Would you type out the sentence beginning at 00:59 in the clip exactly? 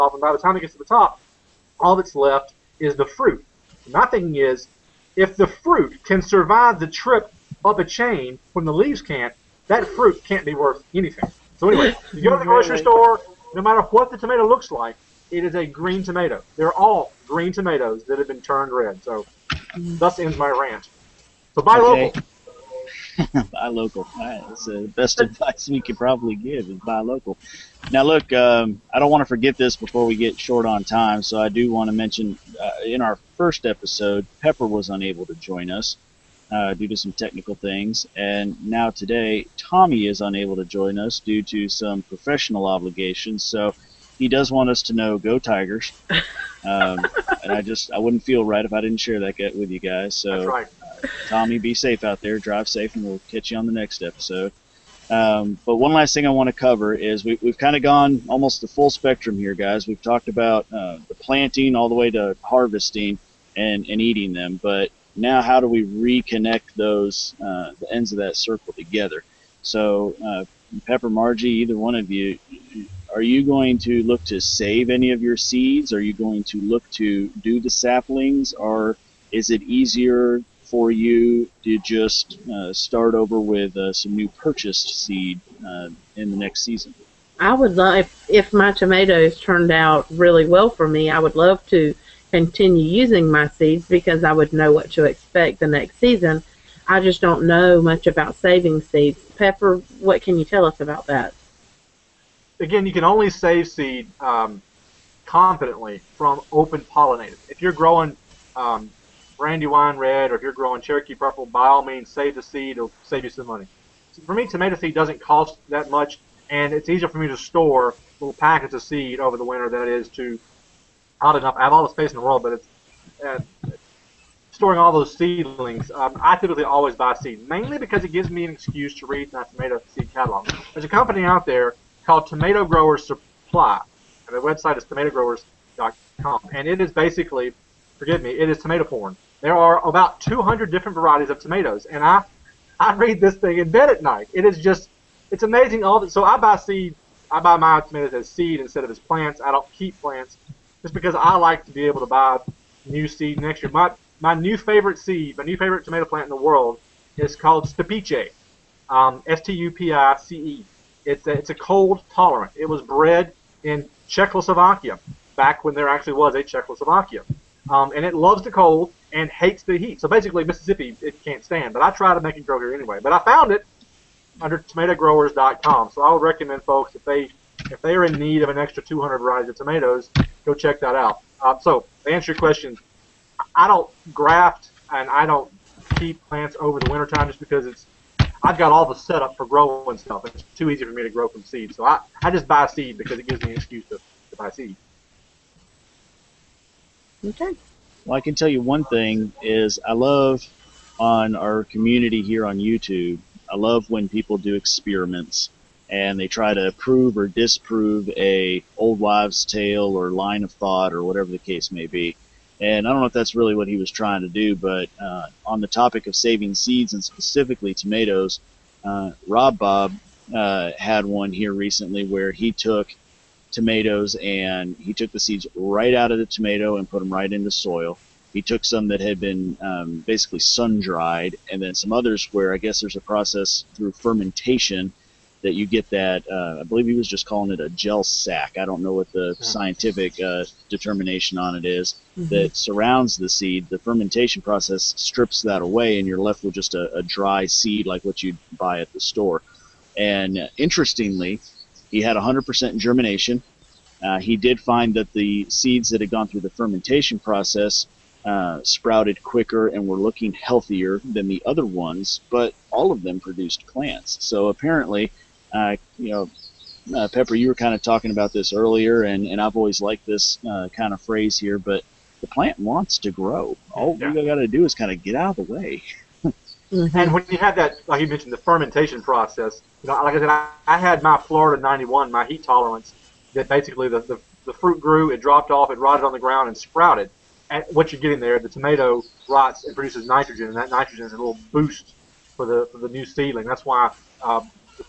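We've talked about uh, the planting all the way to harvesting and, and eating them.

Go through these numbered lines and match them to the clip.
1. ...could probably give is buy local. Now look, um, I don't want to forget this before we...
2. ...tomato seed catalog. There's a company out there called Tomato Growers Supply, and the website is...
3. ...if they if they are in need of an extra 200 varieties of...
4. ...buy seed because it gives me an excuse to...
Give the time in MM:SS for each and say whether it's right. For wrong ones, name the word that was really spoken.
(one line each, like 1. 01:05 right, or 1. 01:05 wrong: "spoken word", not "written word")
1. 00:25 right
2. 02:09 right
3. 02:56 right
4. 03:12 right.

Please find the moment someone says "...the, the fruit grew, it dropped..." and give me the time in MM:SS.
04:44.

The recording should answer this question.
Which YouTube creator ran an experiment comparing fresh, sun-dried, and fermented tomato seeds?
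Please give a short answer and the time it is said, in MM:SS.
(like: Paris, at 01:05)
Rob Bob, at 03:39.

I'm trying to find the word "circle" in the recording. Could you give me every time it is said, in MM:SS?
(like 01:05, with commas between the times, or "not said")
01:08.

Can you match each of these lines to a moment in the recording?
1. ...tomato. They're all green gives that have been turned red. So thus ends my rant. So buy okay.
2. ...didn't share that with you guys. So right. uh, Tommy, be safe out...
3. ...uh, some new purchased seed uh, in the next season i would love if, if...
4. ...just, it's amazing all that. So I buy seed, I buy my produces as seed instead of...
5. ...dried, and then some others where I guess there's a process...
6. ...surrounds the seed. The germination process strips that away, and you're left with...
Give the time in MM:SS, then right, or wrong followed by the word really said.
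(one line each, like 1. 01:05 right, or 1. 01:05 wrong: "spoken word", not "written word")
1. 00:16 wrong: "tomatoes", not "gives"
2. 00:48 right
3. 01:23 right
4. 02:24 wrong: "tomatoes", not "produces"
5. 03:50 right
6. 04:02 wrong: "fermentation", not "germination".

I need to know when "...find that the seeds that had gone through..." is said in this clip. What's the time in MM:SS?
04:14.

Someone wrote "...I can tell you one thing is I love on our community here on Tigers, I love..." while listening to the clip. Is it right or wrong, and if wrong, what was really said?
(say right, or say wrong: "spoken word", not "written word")
wrong: "YouTube", not "Tigers".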